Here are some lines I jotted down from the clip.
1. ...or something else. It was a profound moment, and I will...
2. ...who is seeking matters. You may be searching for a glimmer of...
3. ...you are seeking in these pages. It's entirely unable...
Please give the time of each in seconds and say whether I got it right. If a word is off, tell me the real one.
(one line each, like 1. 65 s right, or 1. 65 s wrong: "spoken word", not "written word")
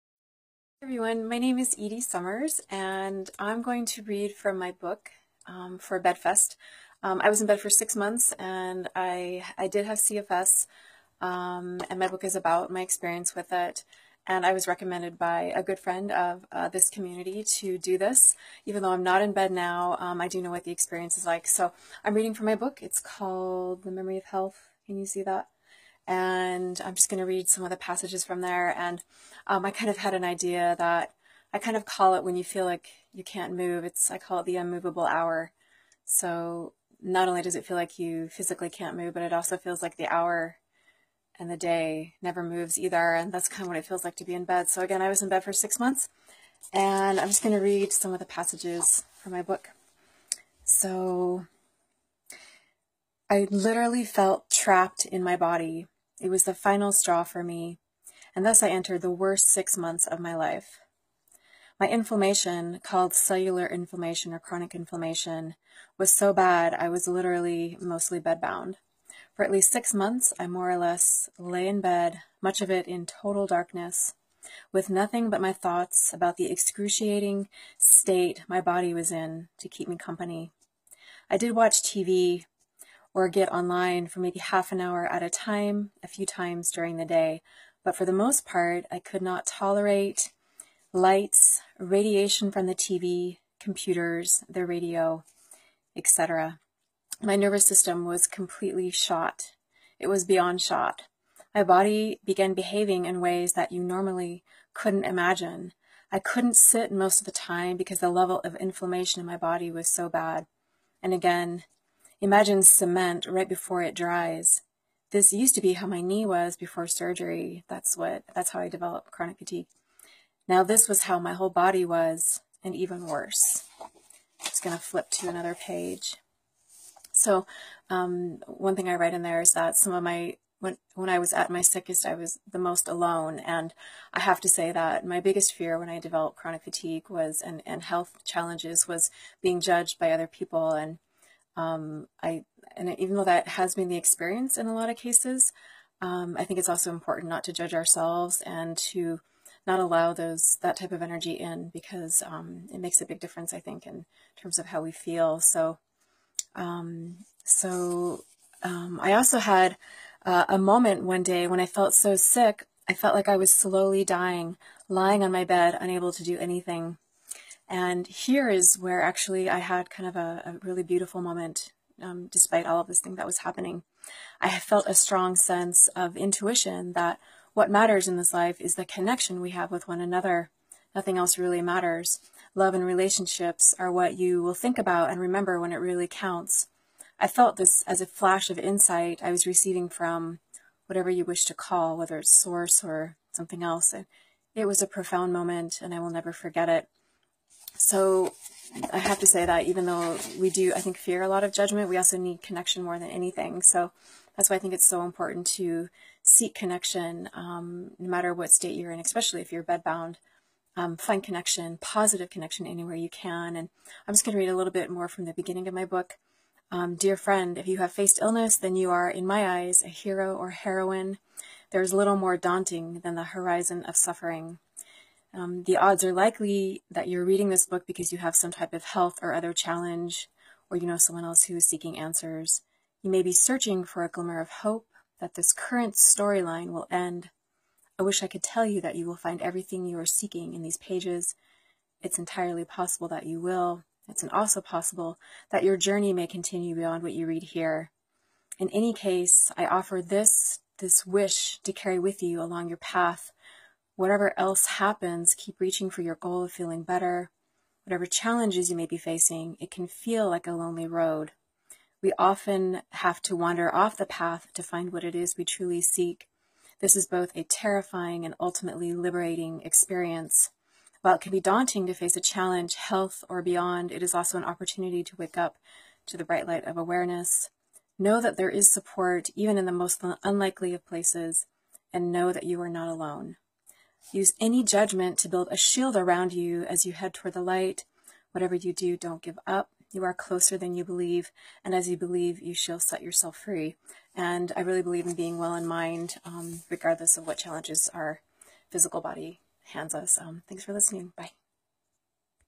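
1. 192 s right
2. 231 s wrong: "answers", not "matters"
3. 239 s wrong: "possible", not "unable".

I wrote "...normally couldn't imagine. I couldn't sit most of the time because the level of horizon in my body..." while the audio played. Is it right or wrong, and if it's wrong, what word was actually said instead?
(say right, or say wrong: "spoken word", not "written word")
wrong: "inflammation", not "horizon".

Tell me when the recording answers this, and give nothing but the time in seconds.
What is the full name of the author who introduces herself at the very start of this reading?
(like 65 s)
1 s.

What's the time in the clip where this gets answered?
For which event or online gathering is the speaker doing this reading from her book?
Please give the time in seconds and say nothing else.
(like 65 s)
5 s.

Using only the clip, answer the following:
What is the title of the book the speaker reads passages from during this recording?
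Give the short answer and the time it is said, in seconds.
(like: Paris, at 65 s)
The Memory of Health, at 23 s.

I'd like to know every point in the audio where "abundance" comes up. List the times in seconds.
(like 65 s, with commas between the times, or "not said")
not said.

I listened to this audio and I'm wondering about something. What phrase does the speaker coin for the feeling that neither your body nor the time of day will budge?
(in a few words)
the unmovable hour.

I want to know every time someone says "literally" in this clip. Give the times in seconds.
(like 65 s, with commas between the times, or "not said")
53 s, 67 s.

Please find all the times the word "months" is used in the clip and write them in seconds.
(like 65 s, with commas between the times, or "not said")
7 s, 45 s, 59 s, 69 s.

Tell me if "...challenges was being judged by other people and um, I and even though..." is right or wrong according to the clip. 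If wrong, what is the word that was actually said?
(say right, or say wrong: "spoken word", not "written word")
right.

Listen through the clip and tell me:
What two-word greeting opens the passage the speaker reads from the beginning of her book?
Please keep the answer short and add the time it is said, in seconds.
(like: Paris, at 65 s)
Dear friend, at 216 s.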